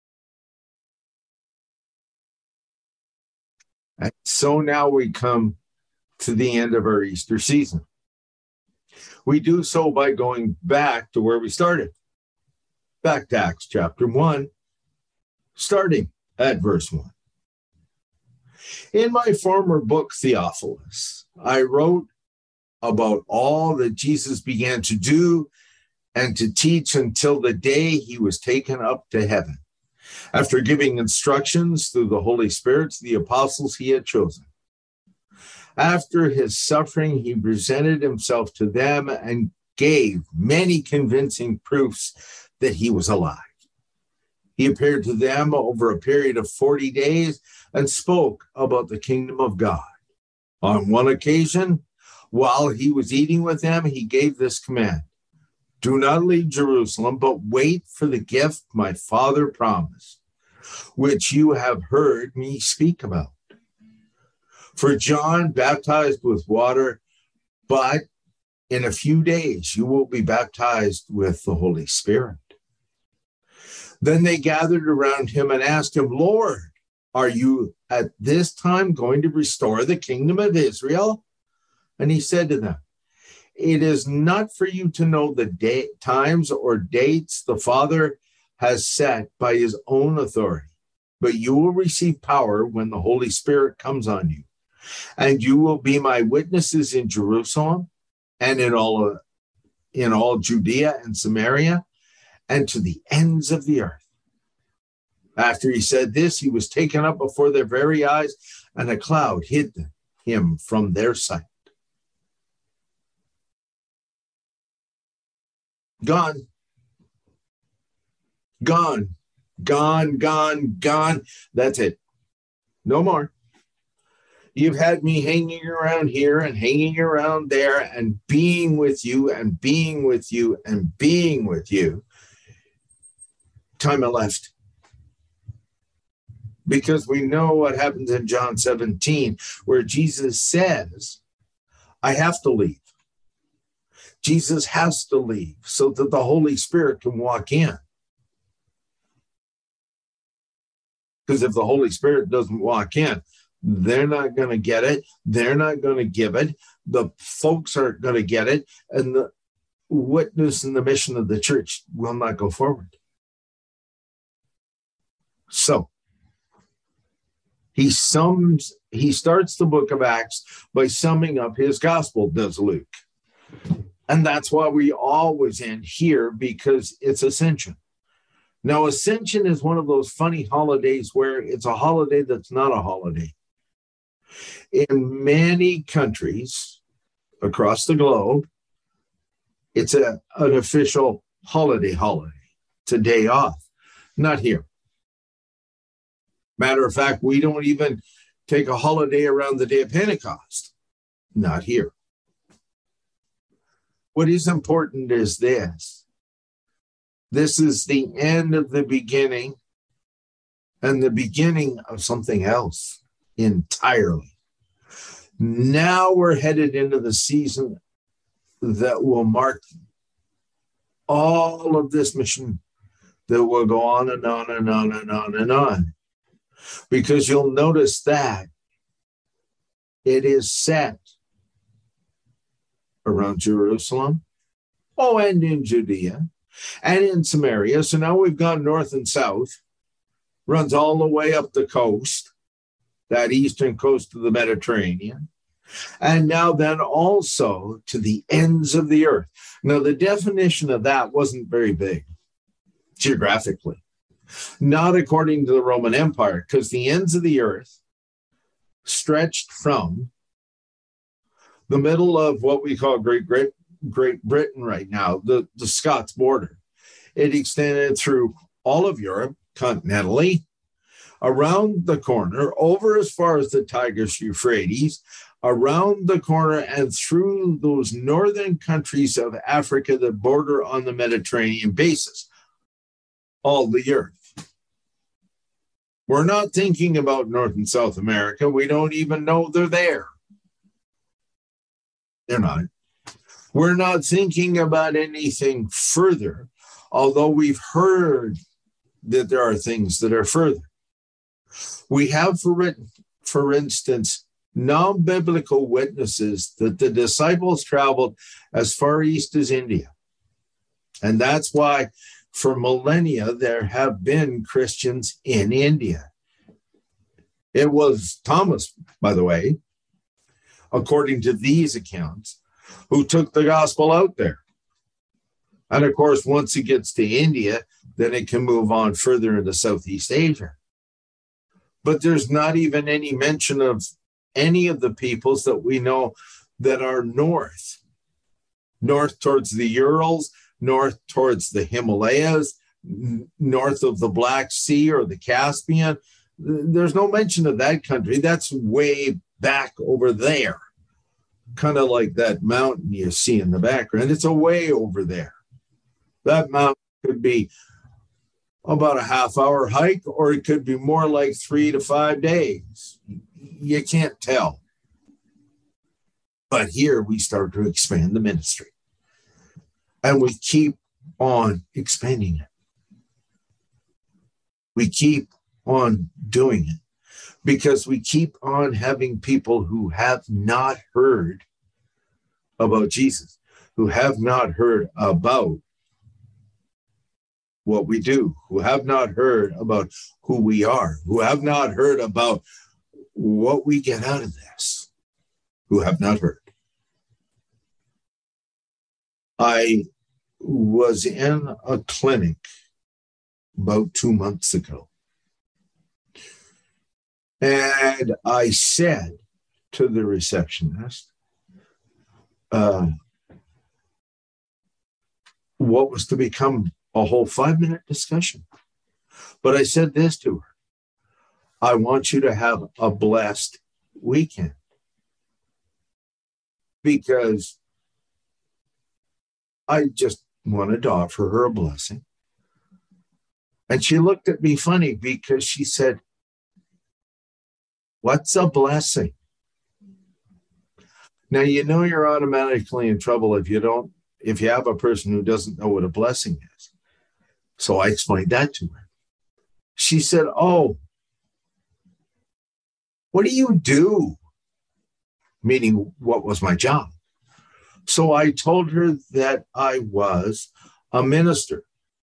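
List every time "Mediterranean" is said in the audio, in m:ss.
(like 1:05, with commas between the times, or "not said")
4:04, 4:40.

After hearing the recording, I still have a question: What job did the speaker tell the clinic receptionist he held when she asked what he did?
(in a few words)
Minister.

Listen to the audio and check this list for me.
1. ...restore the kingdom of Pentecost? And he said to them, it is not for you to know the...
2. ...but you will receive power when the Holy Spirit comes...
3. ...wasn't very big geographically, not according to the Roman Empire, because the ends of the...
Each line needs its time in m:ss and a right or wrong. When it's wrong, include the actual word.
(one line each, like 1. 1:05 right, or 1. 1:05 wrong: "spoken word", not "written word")
1. 1:19 wrong: "Israel", not "Pentecost"
2. 1:31 right
3. 4:11 right.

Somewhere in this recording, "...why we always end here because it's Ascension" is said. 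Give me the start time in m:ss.
2:54.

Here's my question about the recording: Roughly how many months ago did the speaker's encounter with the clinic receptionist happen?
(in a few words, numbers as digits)
2 months.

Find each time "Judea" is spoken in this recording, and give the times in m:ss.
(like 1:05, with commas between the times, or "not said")
1:40, 3:55.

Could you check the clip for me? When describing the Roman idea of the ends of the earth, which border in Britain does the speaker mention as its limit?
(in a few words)
The Scots border.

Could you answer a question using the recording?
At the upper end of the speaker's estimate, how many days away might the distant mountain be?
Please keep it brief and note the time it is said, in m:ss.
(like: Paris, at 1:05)
5 days, at 6:01.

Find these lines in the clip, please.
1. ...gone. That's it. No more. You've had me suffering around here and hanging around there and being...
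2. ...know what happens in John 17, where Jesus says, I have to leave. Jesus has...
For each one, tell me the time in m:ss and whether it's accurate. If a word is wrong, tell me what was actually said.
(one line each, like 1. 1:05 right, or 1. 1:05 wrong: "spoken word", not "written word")
1. 2:00 wrong: "hanging", not "suffering"
2. 2:17 right.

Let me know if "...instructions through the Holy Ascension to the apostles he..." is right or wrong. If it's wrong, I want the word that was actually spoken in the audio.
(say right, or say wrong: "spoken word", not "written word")
wrong: "Spirit", not "Ascension".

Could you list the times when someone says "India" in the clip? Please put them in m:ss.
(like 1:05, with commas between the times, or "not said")
5:09, 5:15, 5:27.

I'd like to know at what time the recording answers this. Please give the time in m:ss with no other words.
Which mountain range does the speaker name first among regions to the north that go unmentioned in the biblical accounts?
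5:39.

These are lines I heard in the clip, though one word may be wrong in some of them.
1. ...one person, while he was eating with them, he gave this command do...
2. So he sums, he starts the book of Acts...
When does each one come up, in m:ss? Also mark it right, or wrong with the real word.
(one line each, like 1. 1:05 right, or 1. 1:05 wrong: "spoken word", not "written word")
1. 0:50 wrong: "occasion", not "person"
2. 2:45 right.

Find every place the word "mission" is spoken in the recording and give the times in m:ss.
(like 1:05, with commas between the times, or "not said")
2:40, 3:42.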